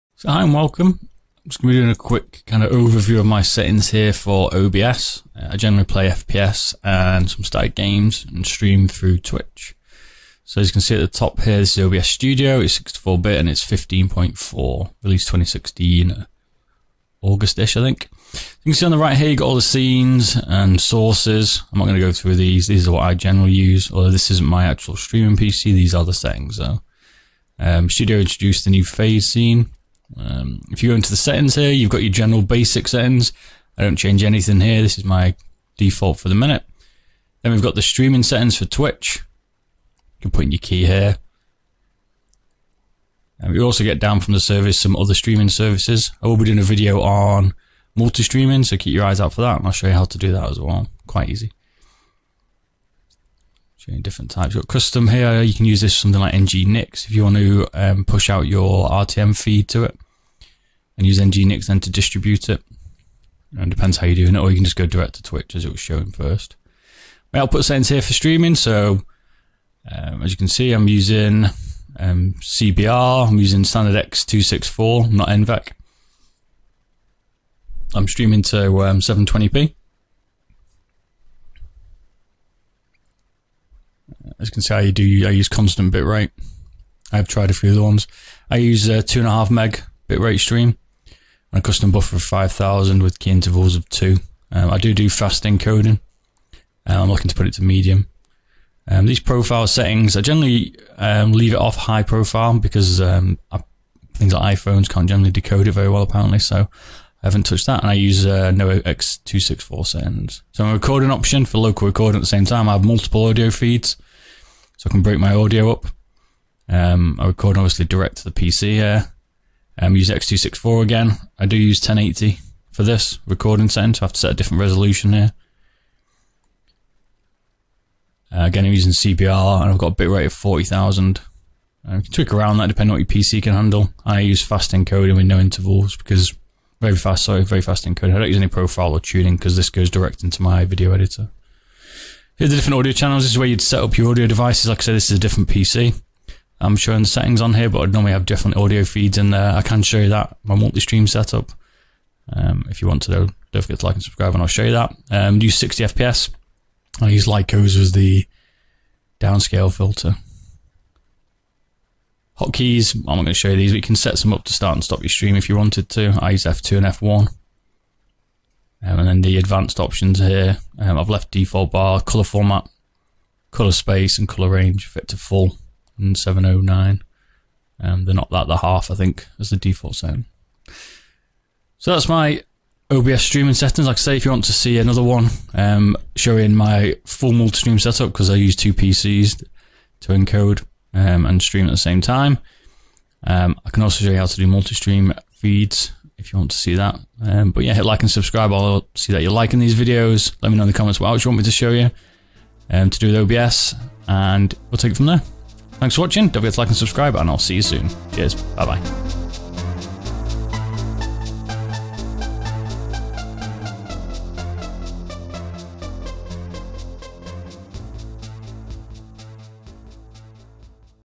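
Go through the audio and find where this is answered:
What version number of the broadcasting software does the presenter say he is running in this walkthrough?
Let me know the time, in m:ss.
0:13.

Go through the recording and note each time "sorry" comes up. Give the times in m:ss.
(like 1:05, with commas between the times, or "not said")
2:17.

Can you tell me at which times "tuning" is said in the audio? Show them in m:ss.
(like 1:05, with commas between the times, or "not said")
2:18.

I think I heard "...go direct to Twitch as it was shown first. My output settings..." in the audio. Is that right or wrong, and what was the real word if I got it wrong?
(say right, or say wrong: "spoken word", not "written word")
right.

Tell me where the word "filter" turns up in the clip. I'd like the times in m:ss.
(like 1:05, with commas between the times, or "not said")
2:39.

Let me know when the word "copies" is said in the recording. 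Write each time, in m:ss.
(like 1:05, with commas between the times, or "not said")
not said.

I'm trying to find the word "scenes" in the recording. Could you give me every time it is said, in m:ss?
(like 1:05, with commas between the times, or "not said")
0:19, 0:29.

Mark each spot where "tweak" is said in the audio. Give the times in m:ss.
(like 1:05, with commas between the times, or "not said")
2:12.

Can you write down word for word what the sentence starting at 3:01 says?
So that's my OBS streaming settings.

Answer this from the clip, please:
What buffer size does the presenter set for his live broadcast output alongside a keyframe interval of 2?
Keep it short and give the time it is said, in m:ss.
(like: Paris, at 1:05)
5,000, at 1:32.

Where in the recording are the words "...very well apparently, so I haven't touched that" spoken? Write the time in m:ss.
1:45.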